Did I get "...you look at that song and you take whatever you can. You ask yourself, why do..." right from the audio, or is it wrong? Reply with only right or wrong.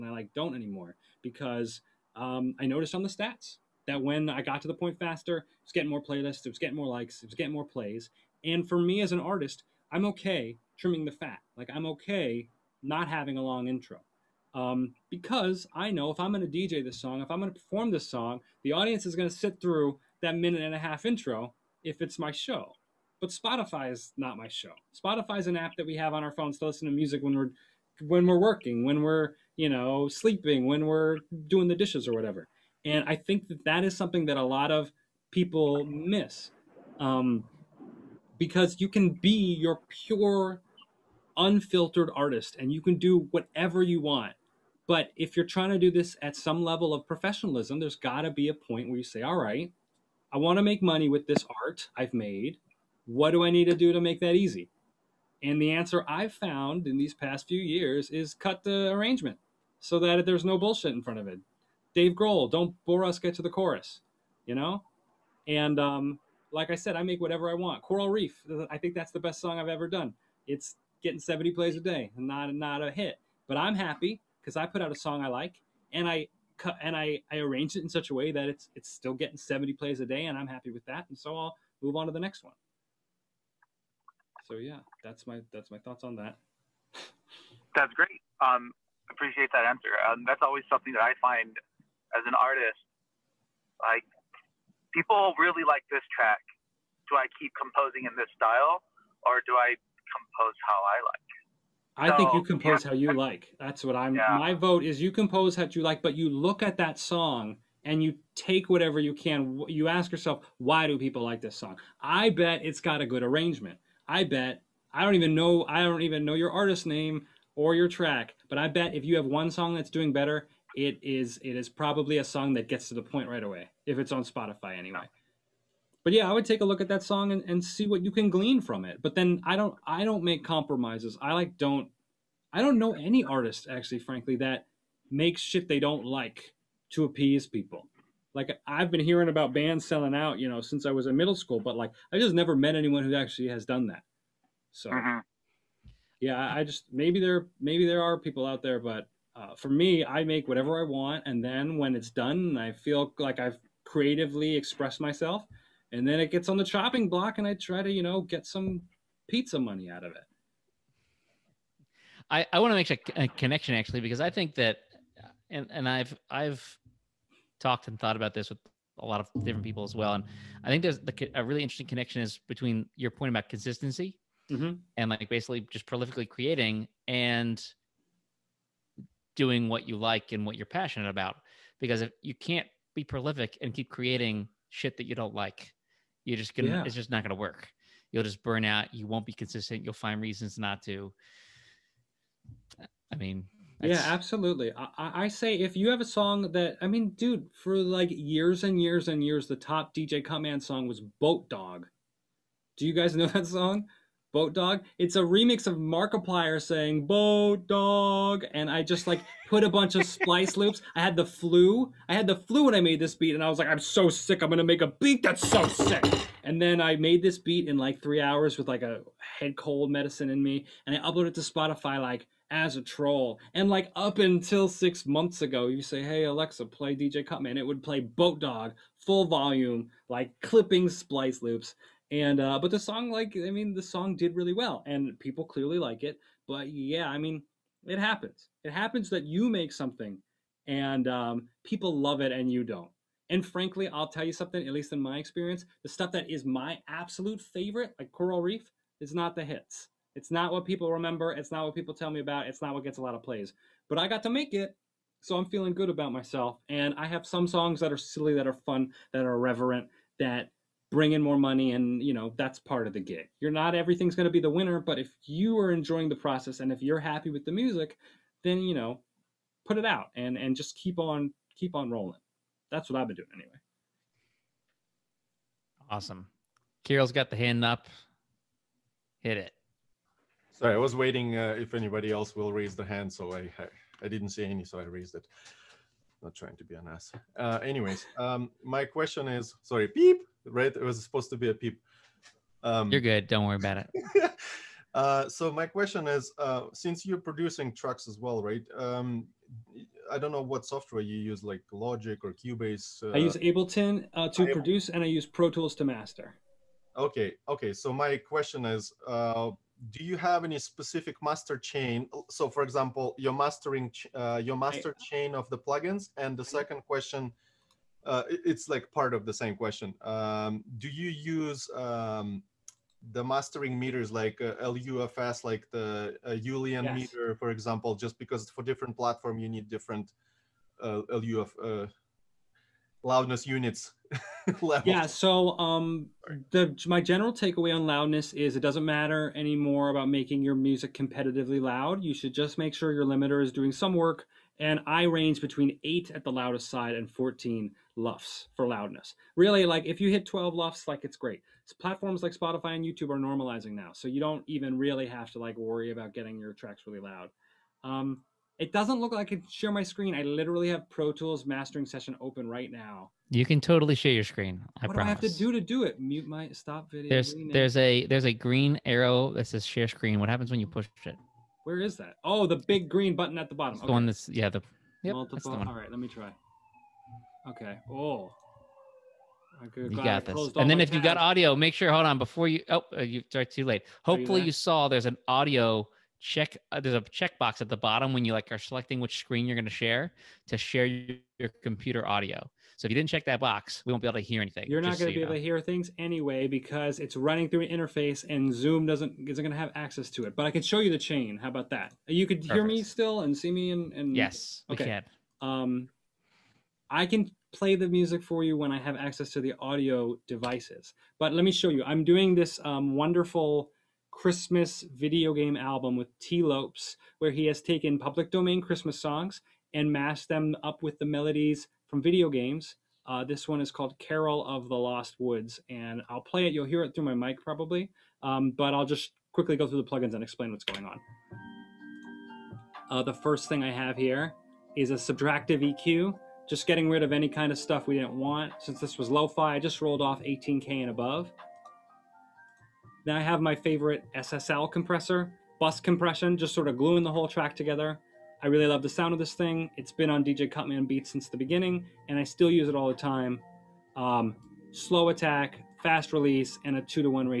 right.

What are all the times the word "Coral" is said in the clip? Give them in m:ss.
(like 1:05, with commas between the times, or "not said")
1:07, 4:08.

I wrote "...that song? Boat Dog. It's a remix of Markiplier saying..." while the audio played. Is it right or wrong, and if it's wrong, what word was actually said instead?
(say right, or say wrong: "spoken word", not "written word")
right.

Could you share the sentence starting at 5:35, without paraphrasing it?
So, um, the my general takeaway on loudness is it doesn't matter anymore about making your music competitively loud.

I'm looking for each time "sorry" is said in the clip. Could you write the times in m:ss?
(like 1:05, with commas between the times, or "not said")
4:40, 4:49.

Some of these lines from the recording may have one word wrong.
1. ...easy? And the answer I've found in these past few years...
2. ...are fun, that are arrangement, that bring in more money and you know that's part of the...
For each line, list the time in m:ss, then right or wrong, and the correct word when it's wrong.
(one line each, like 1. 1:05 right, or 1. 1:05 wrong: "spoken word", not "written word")
1. 0:54 right
2. 4:18 wrong: "irreverent", not "arrangement".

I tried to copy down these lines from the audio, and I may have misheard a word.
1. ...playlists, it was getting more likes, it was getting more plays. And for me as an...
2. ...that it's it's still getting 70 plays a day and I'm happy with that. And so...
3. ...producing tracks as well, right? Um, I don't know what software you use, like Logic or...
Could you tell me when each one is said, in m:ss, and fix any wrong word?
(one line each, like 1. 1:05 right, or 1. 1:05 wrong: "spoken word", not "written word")
1. 0:06 right
2. 1:18 right
3. 4:57 right.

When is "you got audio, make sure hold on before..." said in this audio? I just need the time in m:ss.
6:20.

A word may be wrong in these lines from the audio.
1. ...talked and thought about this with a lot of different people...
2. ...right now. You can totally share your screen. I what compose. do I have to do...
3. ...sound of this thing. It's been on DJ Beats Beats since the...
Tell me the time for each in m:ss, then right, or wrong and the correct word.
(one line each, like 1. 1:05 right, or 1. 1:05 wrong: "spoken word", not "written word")
1. 2:47 right
2. 6:02 wrong: "promise", not "compose"
3. 7:28 wrong: "Cutman", not "Beats".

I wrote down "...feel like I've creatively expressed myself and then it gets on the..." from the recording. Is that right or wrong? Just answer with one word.
right.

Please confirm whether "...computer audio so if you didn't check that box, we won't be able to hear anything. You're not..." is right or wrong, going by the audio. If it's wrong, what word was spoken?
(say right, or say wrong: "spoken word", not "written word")
right.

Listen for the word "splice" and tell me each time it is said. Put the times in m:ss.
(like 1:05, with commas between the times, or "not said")
3:30, 3:50.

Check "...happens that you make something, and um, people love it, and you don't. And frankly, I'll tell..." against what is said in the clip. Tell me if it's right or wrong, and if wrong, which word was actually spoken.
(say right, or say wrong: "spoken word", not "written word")
right.